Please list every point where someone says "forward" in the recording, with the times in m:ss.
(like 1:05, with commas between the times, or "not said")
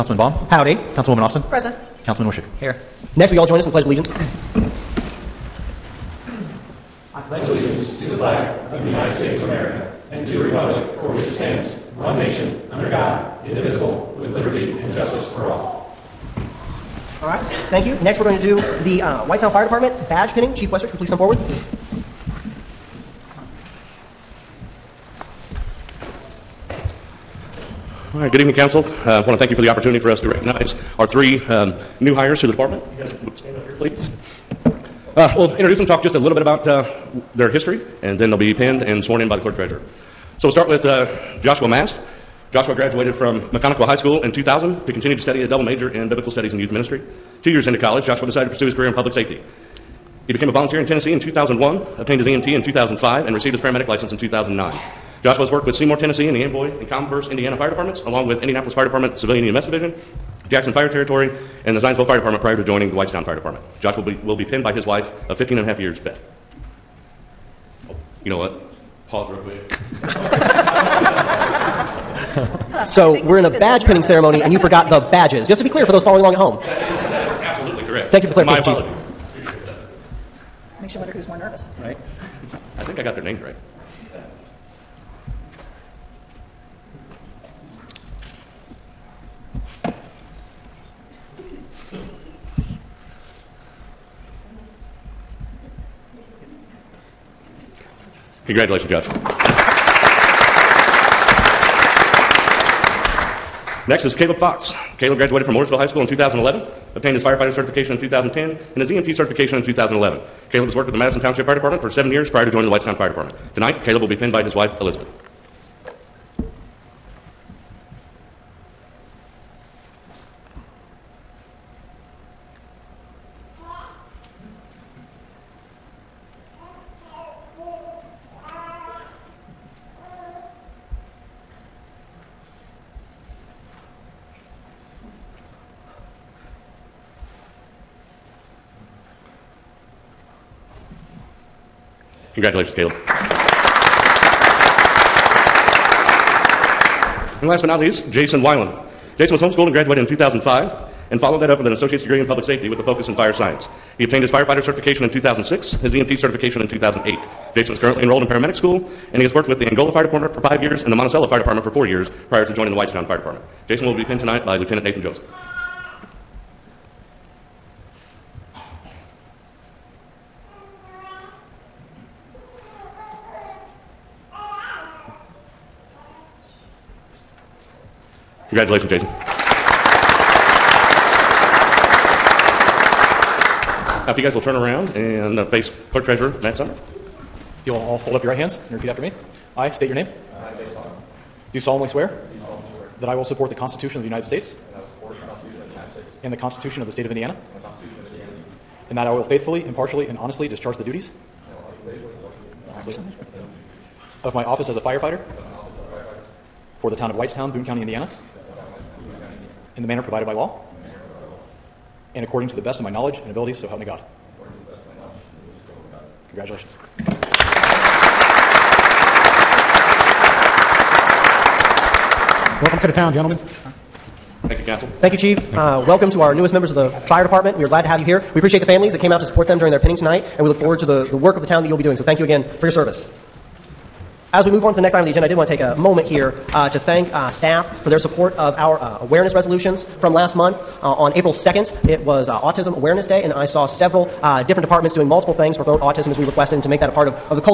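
0:21, 3:50.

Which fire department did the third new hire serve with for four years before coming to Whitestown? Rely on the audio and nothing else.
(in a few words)
Monticello Fire Department.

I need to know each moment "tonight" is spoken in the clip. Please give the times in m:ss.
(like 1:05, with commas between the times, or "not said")
1:53, 2:44, 3:49.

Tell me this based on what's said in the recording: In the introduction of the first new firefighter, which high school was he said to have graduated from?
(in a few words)
McConaughey High School.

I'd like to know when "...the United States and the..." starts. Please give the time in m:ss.
3:14.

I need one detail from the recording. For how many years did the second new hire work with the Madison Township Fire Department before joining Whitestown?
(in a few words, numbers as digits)
7.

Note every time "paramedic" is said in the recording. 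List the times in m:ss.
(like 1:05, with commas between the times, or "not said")
0:53, 2:38.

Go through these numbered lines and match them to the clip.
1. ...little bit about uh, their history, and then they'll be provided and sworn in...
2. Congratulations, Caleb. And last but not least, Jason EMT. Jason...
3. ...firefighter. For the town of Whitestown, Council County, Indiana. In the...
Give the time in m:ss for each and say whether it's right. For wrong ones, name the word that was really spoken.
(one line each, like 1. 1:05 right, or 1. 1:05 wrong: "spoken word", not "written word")
1. 0:36 wrong: "pinned", not "provided"
2. 2:22 wrong: "Weiland", not "EMT"
3. 3:24 wrong: "Boone", not "Council".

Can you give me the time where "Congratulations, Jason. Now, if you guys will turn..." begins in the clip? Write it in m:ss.
2:58.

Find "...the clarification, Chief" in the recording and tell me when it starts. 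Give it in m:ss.
1:18.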